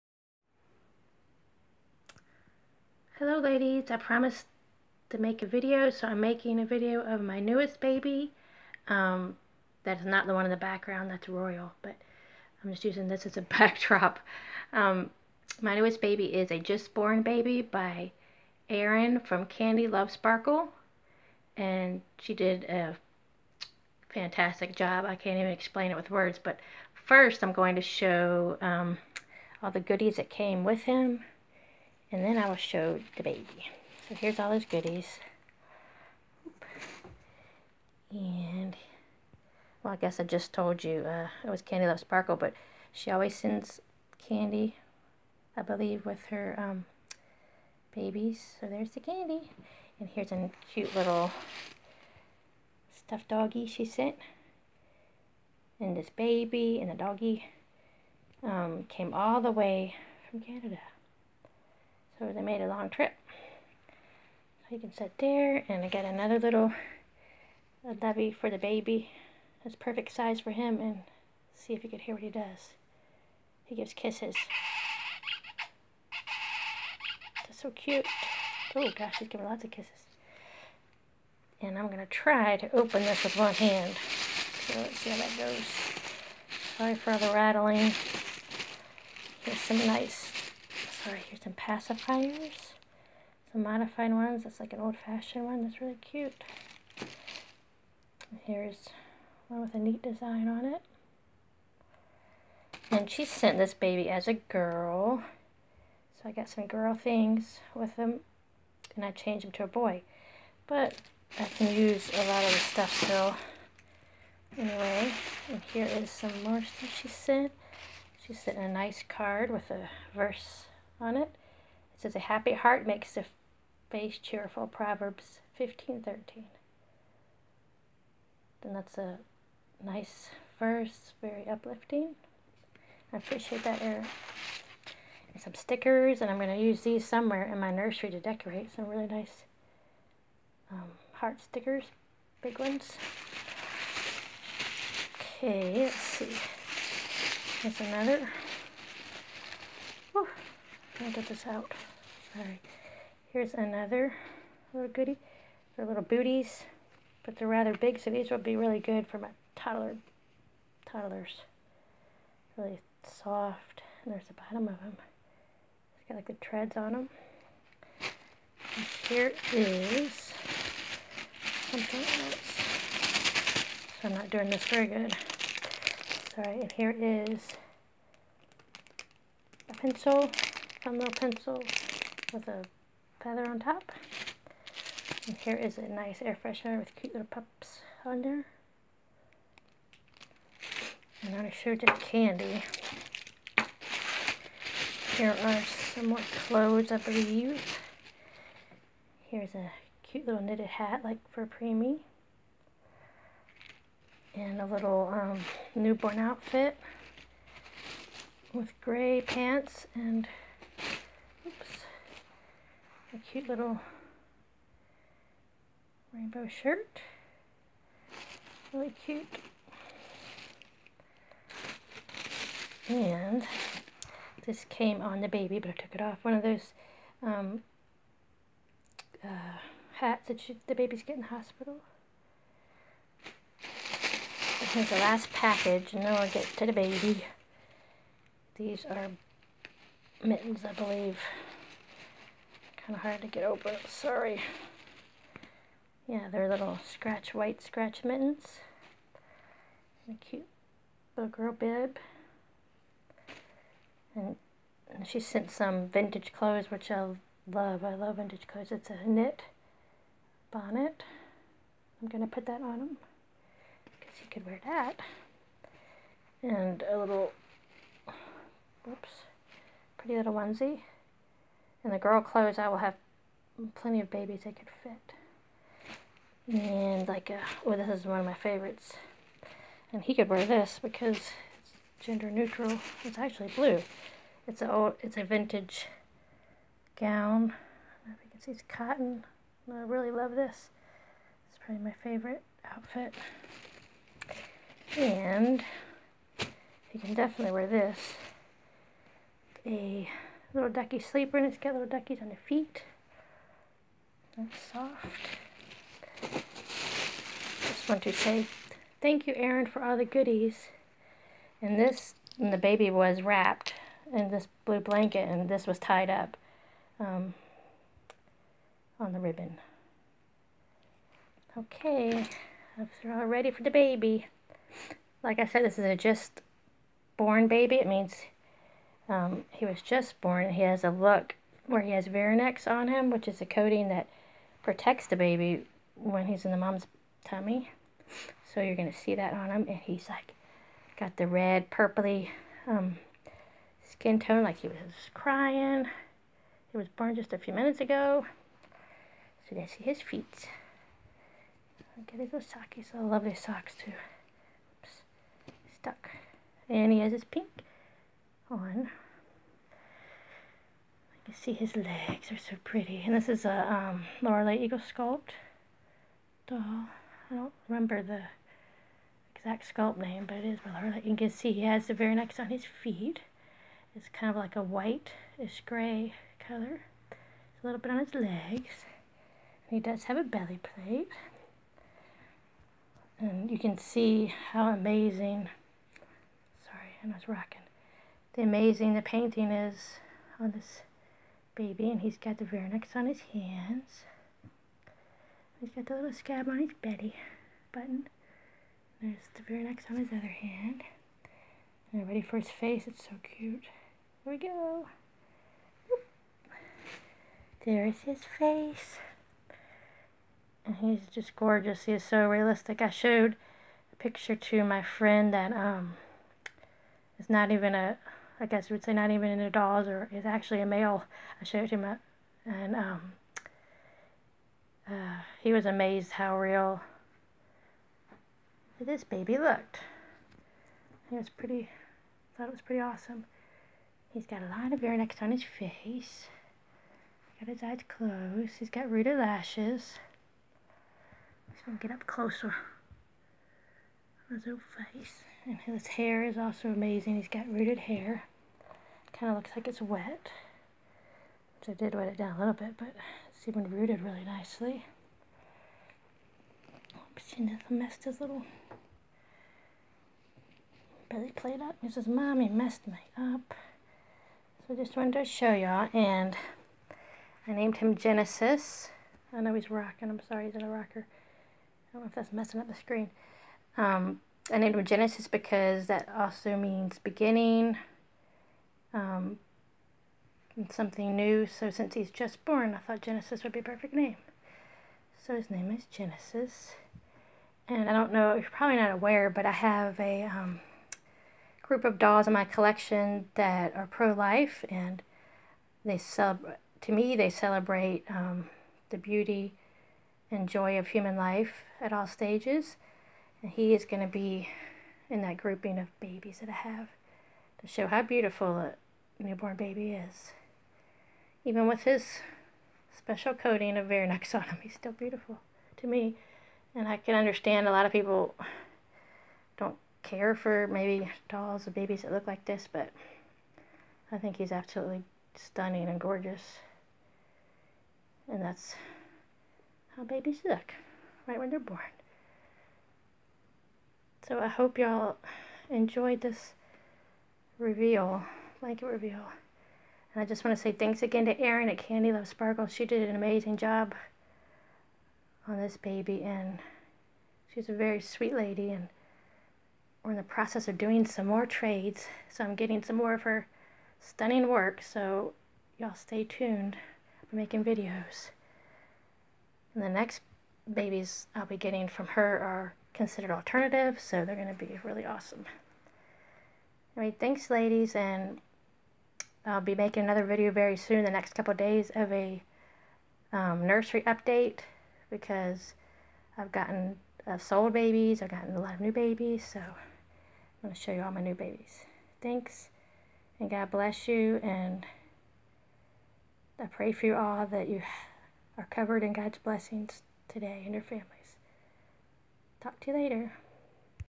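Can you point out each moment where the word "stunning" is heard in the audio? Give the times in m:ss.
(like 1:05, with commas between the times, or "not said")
8:45, 9:13.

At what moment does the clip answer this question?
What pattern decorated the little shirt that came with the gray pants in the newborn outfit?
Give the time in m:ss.
3:36.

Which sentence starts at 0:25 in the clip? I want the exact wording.
I can't even explain it with words, but first I'm going to show um, all the goodies that came with him.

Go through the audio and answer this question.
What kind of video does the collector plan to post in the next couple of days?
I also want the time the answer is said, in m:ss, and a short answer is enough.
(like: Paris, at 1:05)
Nursery update, at 9:33.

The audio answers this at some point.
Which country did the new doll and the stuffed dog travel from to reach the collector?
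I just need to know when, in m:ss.
1:00.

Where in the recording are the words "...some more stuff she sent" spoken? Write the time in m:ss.
1:56.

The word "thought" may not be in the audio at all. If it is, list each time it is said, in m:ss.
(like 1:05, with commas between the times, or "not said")
7:12, 8:02.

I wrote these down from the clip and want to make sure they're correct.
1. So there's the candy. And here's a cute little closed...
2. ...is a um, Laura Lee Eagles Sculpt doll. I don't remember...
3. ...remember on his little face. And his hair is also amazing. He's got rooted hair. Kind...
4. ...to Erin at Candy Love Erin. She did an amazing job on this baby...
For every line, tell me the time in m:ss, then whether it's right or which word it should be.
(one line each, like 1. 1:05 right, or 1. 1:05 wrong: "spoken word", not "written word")
1. 0:48 wrong: "stuffed", not "closed"
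2. 6:03 right
3. 7:22 wrong: "closer", not "remember"
4. 9:01 wrong: "Sparkle", not "Erin".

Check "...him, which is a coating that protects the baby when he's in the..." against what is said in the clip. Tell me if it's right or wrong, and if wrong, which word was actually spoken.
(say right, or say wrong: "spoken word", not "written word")
right.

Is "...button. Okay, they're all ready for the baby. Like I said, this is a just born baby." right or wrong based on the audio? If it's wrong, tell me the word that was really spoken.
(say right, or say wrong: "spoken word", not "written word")
wrong: "ribbon", not "button".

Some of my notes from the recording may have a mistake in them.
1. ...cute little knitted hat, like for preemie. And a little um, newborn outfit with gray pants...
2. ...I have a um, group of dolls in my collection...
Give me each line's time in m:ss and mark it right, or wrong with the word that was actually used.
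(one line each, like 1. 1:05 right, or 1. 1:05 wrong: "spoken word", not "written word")
1. 3:20 right
2. 8:09 right.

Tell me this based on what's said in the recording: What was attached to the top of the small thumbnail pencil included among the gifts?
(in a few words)
A feather.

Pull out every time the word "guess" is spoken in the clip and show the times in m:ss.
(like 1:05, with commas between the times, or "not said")
0:39, 6:58.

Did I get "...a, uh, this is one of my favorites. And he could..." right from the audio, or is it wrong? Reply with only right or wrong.
right.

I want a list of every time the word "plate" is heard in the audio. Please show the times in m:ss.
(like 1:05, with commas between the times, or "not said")
6:20, 7:41.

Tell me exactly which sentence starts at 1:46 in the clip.
So I got some girl things with them, And I changed them to a boy.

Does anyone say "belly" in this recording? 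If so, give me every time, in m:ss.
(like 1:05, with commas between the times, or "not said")
6:20, 6:36, 7:41.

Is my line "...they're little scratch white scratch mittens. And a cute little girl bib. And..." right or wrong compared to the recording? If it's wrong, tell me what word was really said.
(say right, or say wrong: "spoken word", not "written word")
right.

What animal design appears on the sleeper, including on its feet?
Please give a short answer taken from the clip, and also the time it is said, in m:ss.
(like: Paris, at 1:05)
Duckies, at 5:01.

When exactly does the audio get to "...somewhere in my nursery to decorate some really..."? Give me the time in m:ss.
2:17.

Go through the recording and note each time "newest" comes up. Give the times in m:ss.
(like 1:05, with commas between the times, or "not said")
0:07, 0:15.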